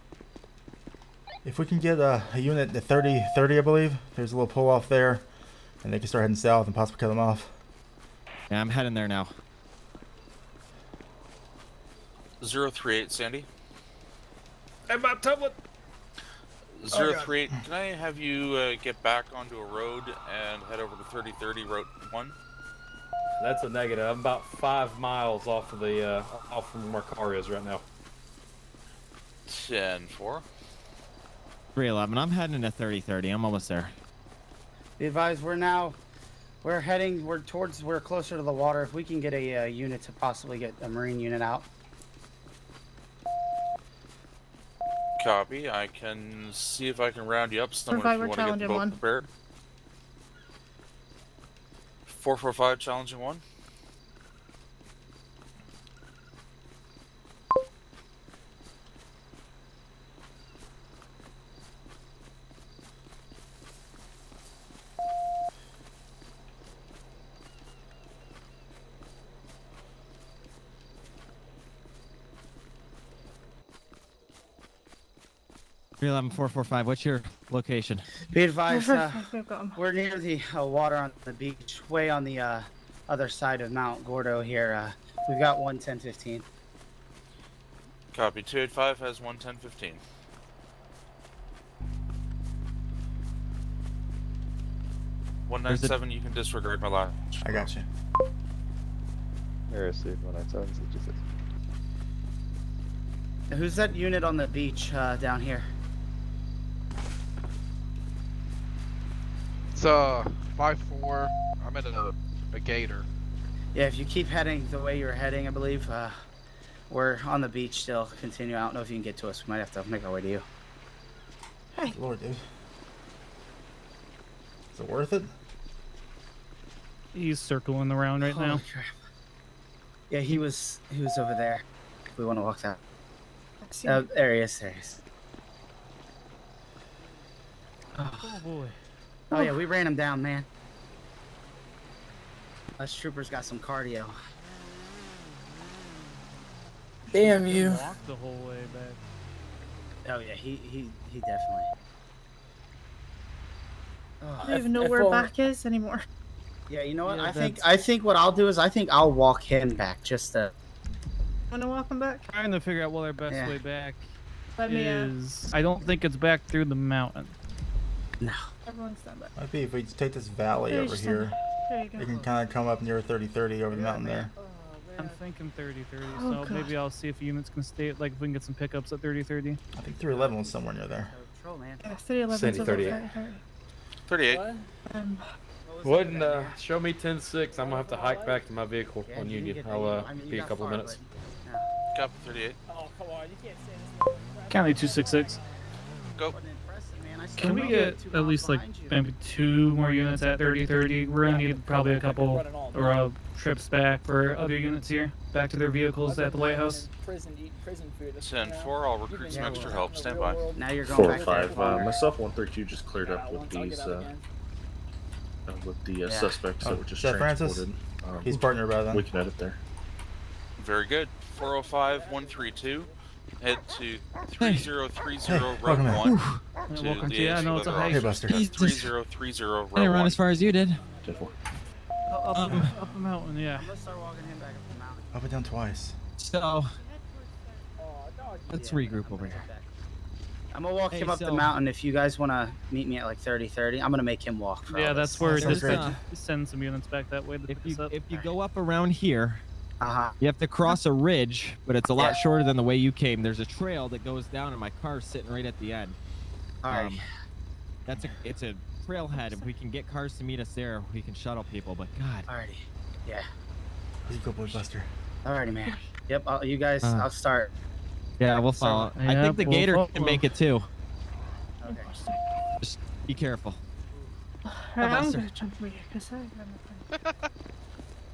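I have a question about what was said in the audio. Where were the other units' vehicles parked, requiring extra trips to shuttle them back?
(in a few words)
the lighthouse.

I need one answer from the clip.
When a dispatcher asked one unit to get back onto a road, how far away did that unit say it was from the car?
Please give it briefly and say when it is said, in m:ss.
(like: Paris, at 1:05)
5 miles, at 0:24.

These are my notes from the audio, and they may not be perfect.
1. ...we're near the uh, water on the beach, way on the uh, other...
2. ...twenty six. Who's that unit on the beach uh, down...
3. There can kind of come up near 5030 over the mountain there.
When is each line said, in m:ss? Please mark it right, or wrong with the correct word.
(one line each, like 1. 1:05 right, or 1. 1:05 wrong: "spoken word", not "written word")
1. 1:19 right
2. 1:40 wrong: "sixty", not "twenty"
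3. 2:51 wrong: "3030", not "5030".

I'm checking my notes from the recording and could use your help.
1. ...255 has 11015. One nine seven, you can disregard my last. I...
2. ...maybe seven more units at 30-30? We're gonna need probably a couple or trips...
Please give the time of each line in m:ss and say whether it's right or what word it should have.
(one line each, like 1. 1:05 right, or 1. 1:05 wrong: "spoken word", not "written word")
1. 1:28 wrong: "285", not "255"
2. 3:18 wrong: "two", not "seven".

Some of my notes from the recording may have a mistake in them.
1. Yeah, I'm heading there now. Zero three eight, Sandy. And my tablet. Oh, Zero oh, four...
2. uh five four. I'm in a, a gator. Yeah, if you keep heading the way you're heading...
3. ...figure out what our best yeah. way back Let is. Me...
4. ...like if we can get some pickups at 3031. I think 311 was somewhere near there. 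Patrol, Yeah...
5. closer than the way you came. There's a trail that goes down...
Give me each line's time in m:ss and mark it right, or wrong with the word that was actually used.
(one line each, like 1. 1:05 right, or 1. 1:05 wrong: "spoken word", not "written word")
1. 0:08 wrong: "three", not "four"
2. 1:49 right
3. 2:42 right
4. 2:57 wrong: "3030", not "3031"
5. 4:12 wrong: "shorter", not "closer".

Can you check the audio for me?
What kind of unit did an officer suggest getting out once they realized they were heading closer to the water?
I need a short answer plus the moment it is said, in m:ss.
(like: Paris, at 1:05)
marine unit, at 0:40.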